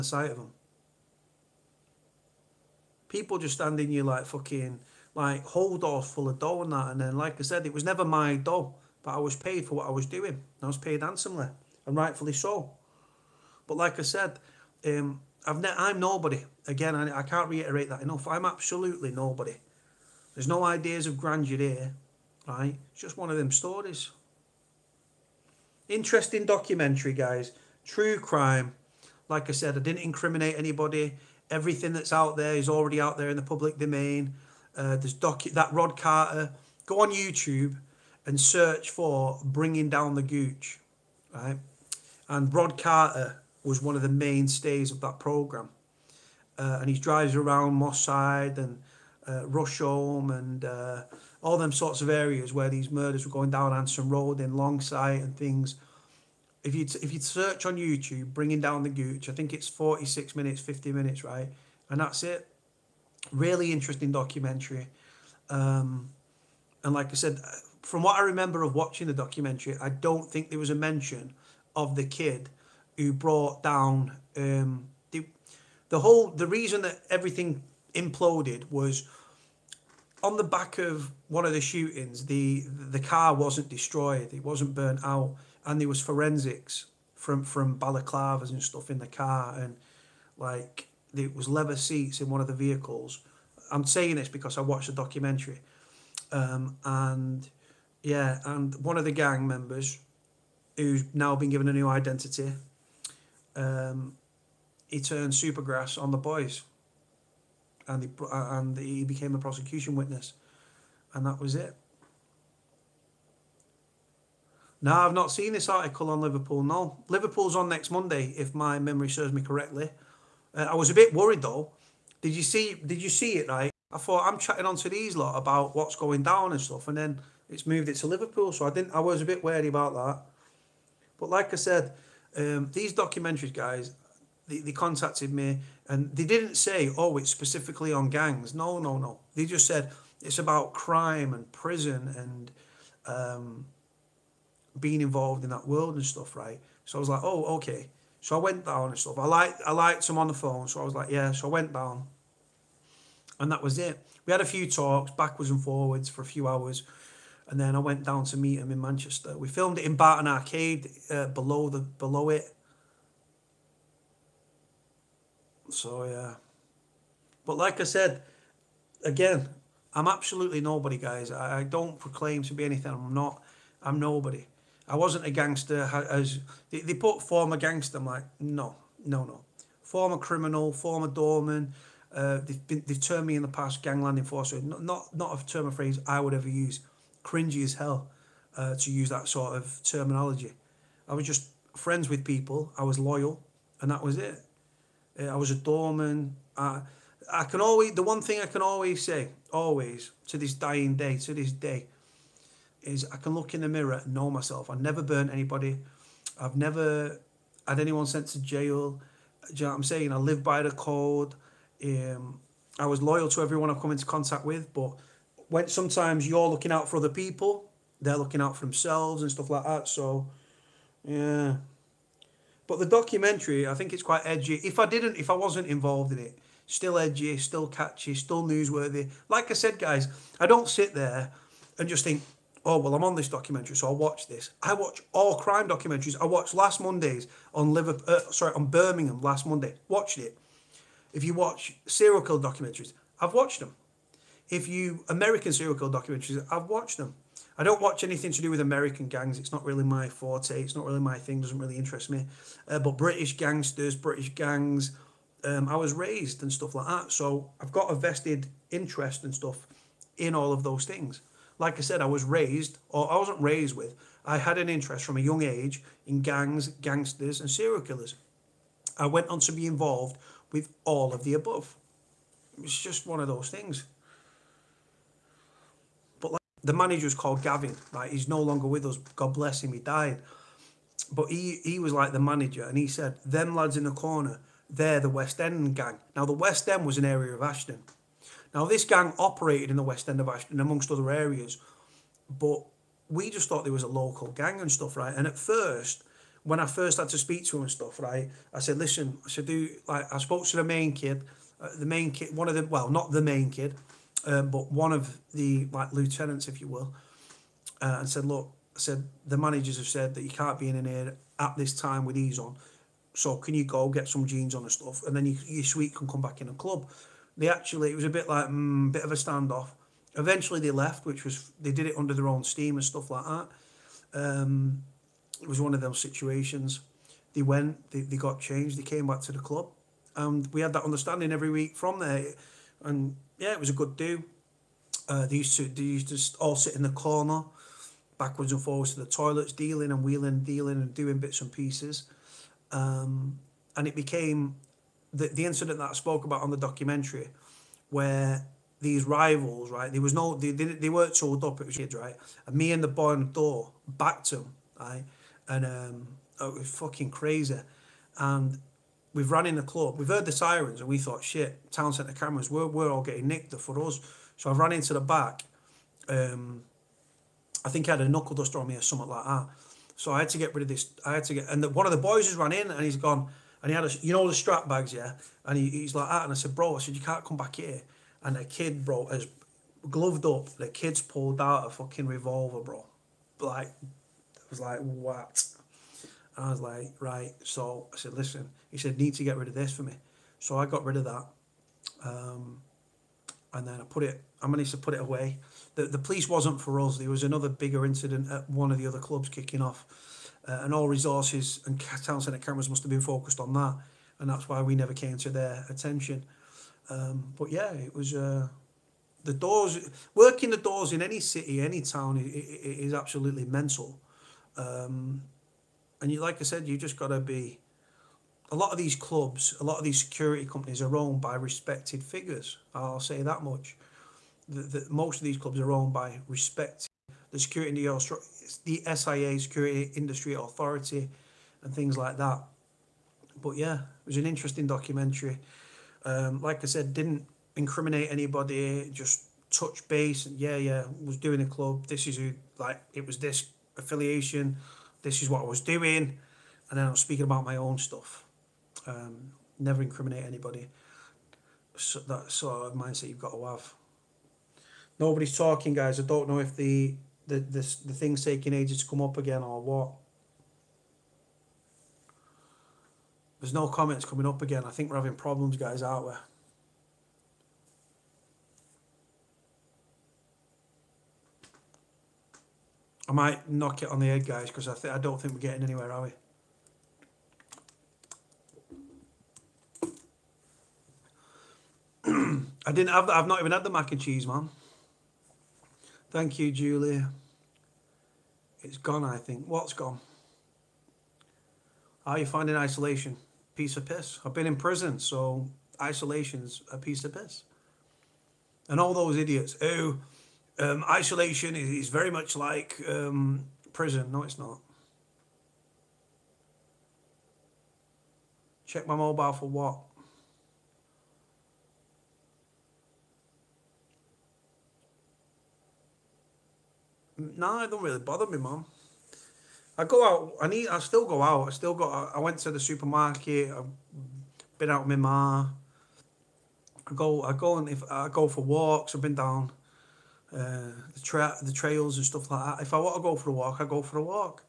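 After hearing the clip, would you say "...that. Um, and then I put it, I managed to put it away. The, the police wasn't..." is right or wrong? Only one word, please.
right.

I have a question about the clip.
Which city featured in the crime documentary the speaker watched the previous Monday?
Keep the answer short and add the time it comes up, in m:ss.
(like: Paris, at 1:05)
Birmingham, at 3:58.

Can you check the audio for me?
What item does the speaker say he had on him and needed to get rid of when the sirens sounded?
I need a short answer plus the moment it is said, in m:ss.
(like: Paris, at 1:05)
A knuckle duster, at 6:08.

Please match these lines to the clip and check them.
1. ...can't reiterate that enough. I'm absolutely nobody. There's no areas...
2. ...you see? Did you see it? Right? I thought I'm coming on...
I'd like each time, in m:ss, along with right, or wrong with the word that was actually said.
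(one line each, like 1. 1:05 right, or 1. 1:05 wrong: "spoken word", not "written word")
1. 0:17 wrong: "ideas", not "areas"
2. 2:02 wrong: "chatting", not "coming".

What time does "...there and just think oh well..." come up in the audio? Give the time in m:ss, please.
3:50.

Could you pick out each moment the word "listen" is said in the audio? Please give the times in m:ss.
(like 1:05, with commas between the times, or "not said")
4:58, 6:28.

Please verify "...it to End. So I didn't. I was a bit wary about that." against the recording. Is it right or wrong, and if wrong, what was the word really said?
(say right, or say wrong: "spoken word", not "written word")
wrong: "Liverpool", not "End".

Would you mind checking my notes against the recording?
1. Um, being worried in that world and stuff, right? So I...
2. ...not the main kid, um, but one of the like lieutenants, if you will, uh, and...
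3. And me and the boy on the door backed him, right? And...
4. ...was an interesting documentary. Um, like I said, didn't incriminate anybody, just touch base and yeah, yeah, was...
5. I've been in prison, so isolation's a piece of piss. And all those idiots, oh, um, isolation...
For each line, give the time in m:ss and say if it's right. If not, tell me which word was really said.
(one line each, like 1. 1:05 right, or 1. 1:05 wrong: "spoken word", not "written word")
1. 2:23 wrong: "involved", not "worried"
2. 5:02 right
3. 5:52 right
4. 7:14 right
5. 8:14 right.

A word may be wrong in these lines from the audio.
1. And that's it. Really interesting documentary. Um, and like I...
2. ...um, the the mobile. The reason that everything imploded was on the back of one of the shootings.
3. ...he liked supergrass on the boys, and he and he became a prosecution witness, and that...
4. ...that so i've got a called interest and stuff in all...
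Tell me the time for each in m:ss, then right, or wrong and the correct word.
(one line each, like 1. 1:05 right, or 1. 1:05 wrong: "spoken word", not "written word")
1. 1:01 right
2. 1:14 wrong: "whole", not "mobile"
3. 1:44 wrong: "turned", not "liked"
4. 4:16 wrong: "vested", not "called".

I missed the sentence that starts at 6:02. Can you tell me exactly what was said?
We're we're all getting nicked for us.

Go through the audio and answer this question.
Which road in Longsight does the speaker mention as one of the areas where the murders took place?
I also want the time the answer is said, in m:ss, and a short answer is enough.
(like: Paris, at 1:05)
Anson Road, at 0:53.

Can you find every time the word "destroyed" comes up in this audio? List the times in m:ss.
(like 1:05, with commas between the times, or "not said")
1:23.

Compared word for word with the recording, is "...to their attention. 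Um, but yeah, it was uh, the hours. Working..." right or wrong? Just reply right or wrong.
wrong.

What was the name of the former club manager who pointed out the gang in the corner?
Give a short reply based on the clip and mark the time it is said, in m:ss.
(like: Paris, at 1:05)
Gavin, at 4:37.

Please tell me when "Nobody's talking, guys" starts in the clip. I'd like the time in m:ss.
7:34.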